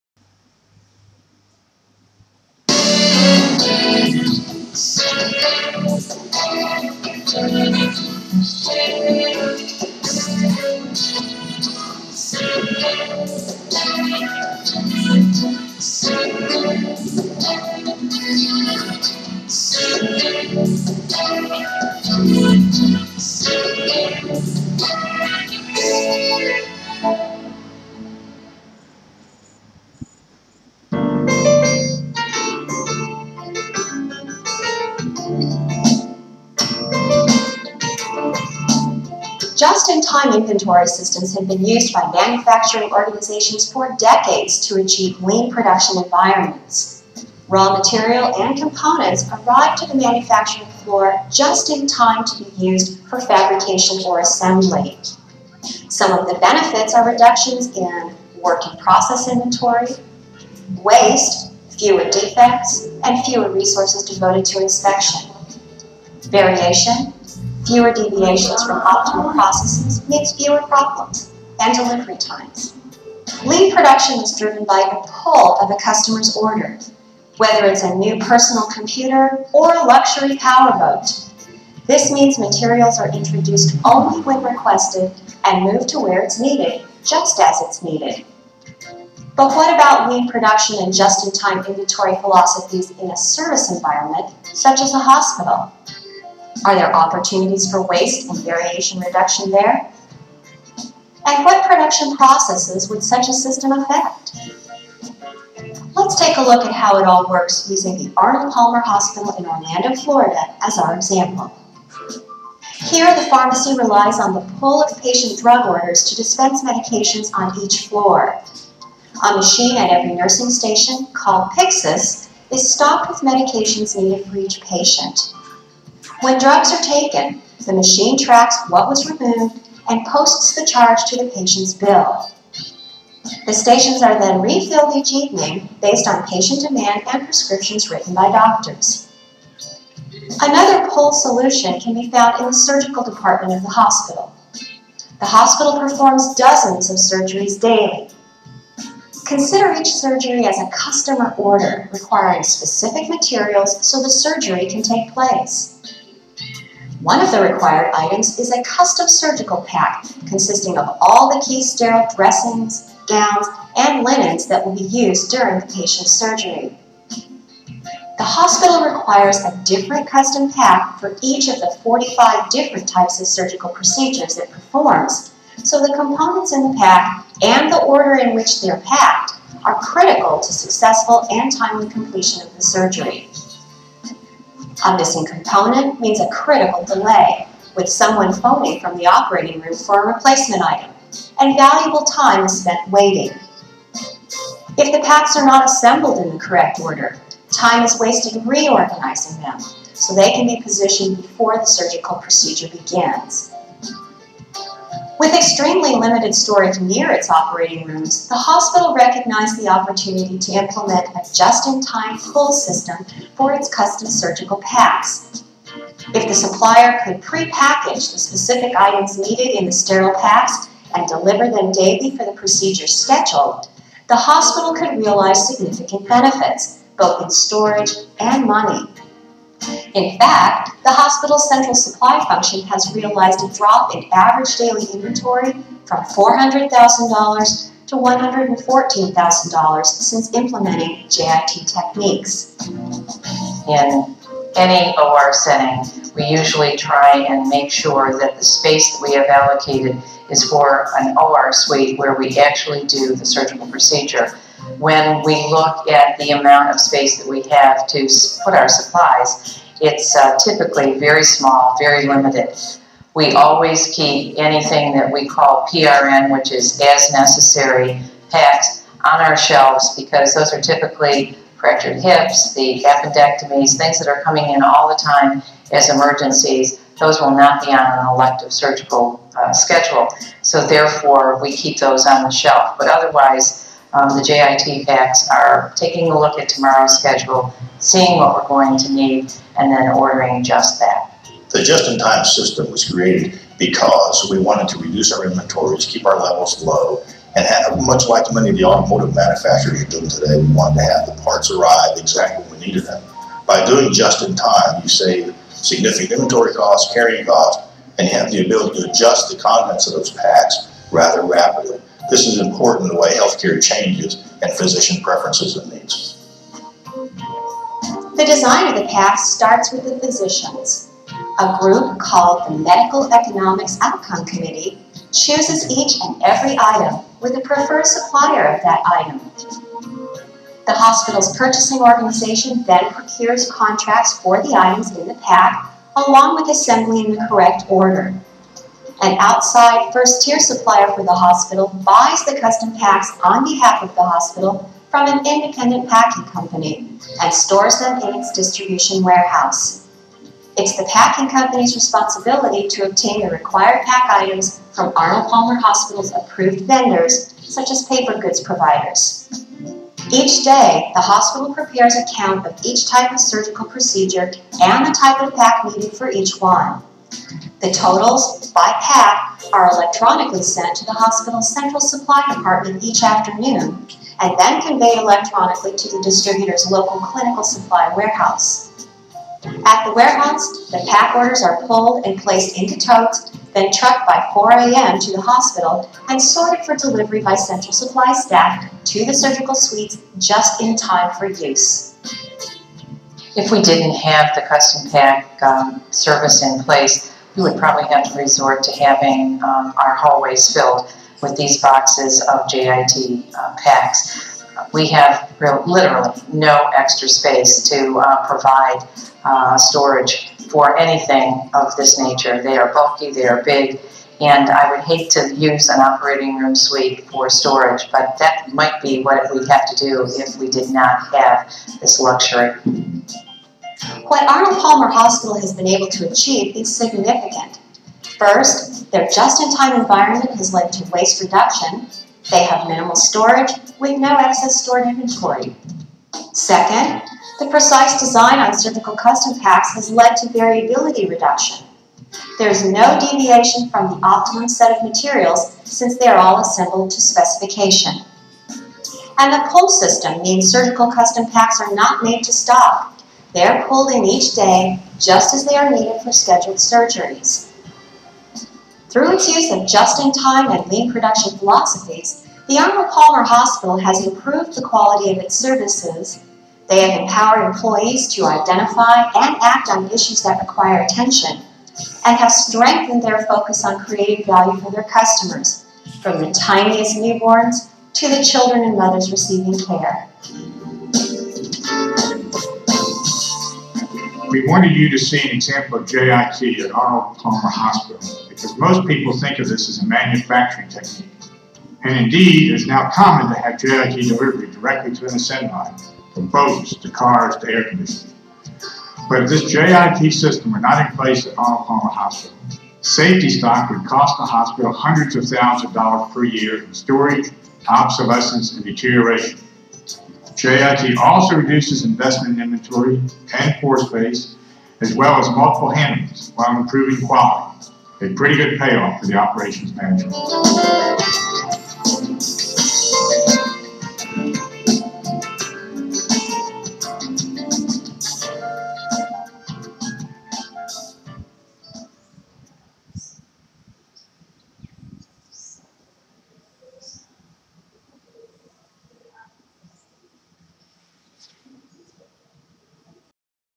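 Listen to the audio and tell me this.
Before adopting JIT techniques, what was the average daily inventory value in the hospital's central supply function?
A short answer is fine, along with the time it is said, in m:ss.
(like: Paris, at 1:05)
$400,000, at 3:56.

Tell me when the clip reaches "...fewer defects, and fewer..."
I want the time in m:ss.
1:01.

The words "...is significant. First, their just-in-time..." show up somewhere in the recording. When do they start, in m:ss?
7:06.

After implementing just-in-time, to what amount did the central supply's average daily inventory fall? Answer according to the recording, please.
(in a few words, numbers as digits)
$114,000.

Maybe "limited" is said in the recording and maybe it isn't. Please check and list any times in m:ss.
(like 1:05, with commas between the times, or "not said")
3:25, 4:22.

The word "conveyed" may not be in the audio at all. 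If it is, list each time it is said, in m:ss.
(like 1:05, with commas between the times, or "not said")
6:14.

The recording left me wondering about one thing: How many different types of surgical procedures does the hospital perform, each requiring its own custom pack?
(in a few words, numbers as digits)
45.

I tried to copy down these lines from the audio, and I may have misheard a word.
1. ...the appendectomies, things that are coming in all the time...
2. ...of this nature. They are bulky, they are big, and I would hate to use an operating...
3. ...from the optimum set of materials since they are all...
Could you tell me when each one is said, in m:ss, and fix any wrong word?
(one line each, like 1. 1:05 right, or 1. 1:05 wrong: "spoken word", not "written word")
1. 4:32 right
2. 6:51 right
3. 7:23 right.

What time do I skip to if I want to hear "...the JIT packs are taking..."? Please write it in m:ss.
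4:44.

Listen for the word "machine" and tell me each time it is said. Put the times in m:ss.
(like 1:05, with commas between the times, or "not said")
1:59, 2:07.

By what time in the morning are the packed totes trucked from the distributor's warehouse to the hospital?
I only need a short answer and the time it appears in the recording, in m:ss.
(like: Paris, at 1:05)
4 a.m., at 6:24.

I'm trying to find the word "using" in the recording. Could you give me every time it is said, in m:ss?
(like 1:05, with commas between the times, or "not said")
1:47.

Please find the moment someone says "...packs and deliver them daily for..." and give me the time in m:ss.
3:40.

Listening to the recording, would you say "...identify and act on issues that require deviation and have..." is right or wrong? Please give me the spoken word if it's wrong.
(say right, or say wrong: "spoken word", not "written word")
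wrong: "attention", not "deviation".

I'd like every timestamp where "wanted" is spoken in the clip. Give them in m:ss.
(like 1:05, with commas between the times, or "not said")
4:54, 5:00, 8:04.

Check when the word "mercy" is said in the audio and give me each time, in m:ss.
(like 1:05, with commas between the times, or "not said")
not said.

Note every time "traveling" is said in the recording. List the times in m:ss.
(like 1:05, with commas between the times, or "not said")
not said.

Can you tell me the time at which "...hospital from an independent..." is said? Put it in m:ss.
5:44.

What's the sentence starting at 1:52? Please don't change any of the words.
Here, the pharmacy relies on the pull of patient drug orders to dispense medications on each floor.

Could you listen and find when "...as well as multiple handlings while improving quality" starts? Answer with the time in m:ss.
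8:34.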